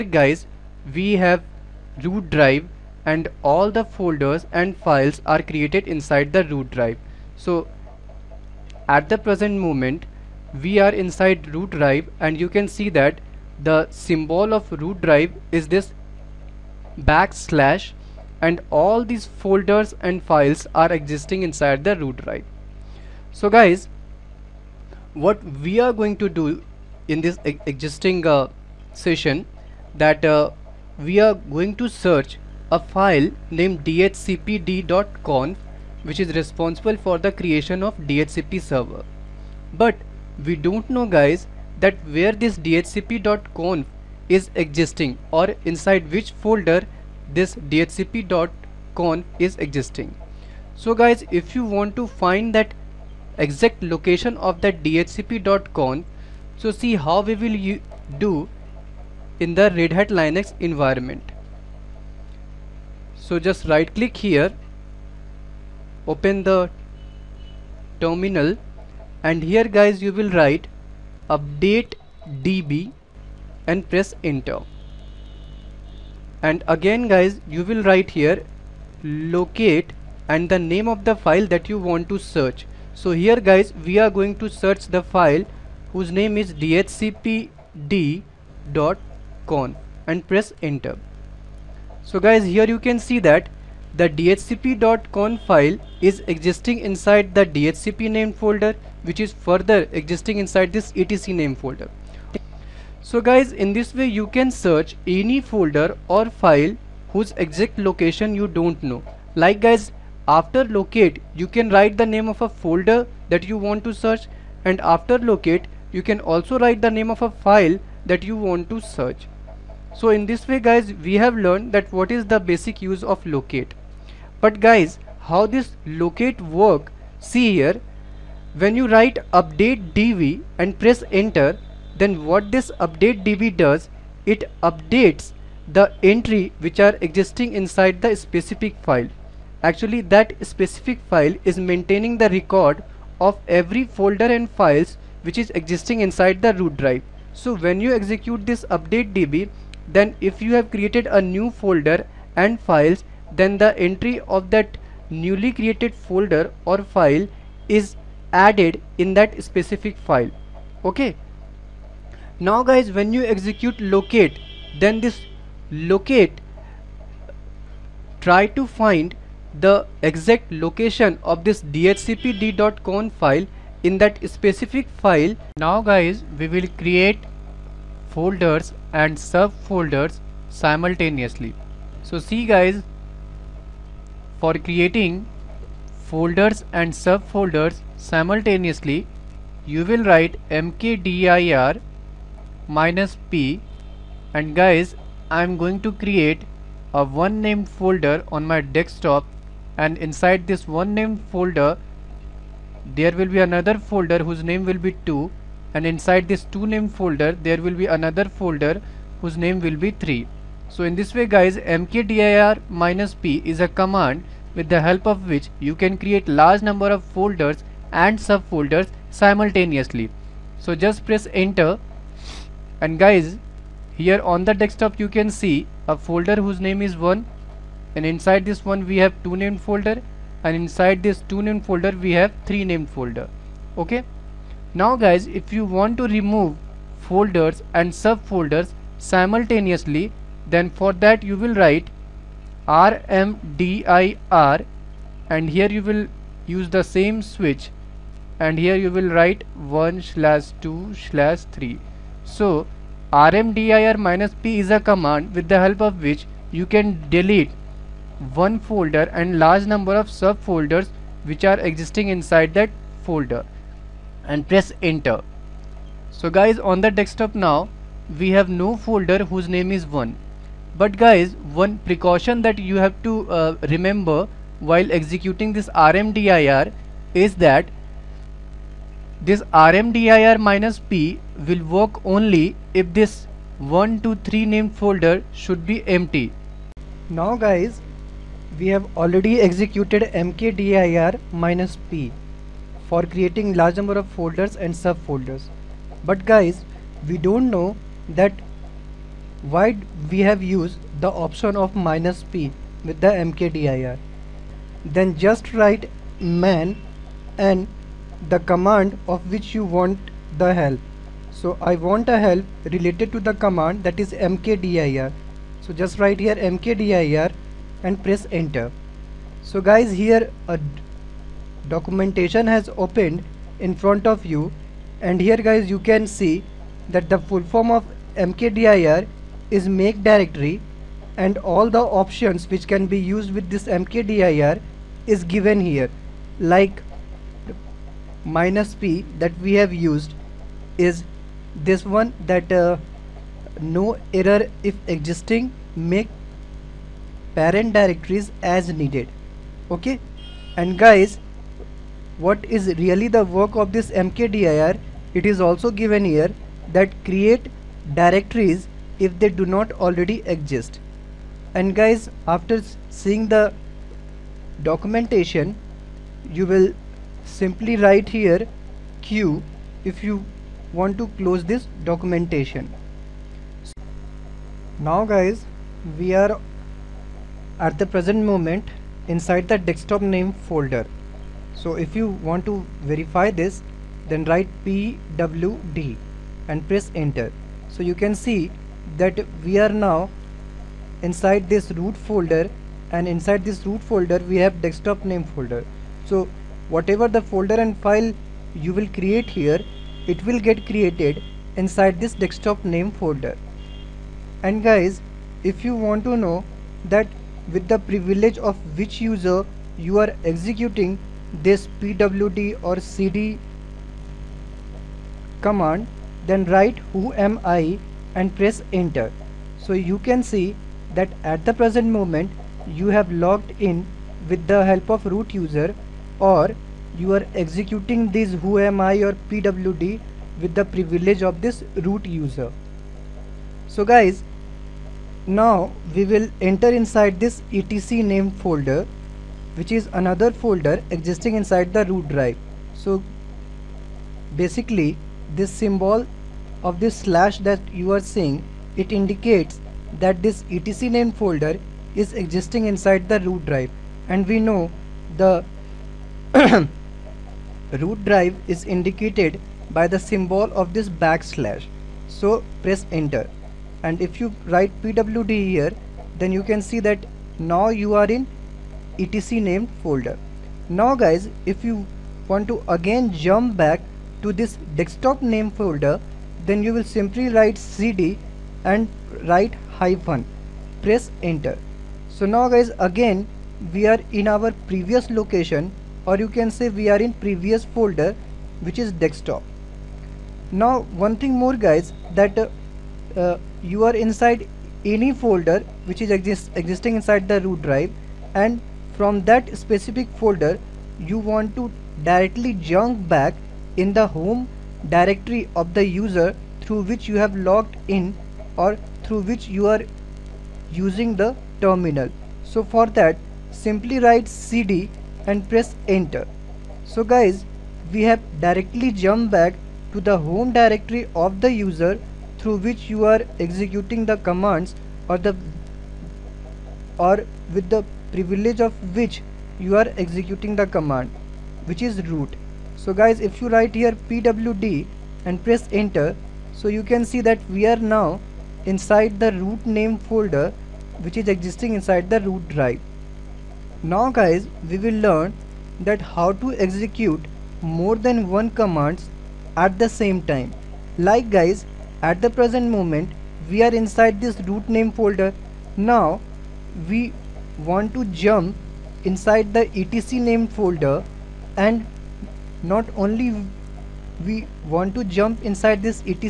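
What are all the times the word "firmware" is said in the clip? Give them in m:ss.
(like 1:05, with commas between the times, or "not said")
not said.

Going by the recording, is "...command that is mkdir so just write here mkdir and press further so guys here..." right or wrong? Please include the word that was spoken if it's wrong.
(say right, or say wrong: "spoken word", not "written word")
wrong: "enter", not "further".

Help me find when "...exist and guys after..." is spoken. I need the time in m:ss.
6:00.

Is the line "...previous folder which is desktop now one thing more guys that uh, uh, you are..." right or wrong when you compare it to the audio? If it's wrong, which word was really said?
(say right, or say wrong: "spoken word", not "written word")
right.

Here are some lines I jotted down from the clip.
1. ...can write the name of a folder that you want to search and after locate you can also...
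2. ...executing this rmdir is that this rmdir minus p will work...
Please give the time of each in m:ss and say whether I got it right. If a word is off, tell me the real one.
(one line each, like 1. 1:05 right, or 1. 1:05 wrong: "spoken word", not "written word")
1. 1:51 right
2. 4:34 right.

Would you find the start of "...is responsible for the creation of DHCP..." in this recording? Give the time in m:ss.
0:36.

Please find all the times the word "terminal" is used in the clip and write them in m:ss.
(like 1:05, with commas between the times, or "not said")
1:07, 8:31.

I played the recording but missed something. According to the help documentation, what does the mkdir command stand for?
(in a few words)
make directory.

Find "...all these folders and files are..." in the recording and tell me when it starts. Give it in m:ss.
0:18.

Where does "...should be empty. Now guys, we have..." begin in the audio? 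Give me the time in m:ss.
4:45.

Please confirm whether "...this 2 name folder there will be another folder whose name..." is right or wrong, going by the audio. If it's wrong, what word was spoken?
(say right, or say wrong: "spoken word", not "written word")
right.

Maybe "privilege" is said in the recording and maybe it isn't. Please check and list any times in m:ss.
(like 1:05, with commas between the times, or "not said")
6:47, 7:10, 8:48.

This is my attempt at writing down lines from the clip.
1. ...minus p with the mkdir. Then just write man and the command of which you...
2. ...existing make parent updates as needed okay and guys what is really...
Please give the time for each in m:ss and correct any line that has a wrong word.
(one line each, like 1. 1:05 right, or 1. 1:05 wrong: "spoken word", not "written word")
1. 5:01 right
2. 5:44 wrong: "directories", not "updates".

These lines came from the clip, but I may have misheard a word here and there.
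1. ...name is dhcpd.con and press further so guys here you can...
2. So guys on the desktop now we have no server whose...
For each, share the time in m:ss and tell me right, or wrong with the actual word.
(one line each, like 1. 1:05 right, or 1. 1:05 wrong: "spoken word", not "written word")
1. 1:26 wrong: "enter", not "further"
2. 4:26 wrong: "folder", not "server".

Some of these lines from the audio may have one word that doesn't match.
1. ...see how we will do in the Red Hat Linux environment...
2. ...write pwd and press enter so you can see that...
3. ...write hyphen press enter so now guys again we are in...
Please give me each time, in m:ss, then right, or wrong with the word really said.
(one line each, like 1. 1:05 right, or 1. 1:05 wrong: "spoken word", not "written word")
1. 0:56 right
2. 6:24 right
3. 7:59 right.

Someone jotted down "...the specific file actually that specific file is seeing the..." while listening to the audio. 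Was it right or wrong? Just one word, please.
wrong.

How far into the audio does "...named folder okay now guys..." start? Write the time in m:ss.
3:52.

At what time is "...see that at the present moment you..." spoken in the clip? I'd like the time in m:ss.
7:00.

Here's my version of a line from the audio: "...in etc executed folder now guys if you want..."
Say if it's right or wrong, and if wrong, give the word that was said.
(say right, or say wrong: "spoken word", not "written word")
wrong: "named", not "executed".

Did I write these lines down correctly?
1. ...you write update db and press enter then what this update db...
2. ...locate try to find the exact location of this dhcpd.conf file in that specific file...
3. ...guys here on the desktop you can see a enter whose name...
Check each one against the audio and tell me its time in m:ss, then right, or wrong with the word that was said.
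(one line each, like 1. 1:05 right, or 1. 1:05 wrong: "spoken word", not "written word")
1. 2:08 right
2. 2:45 right
3. 3:42 wrong: "folder", not "enter".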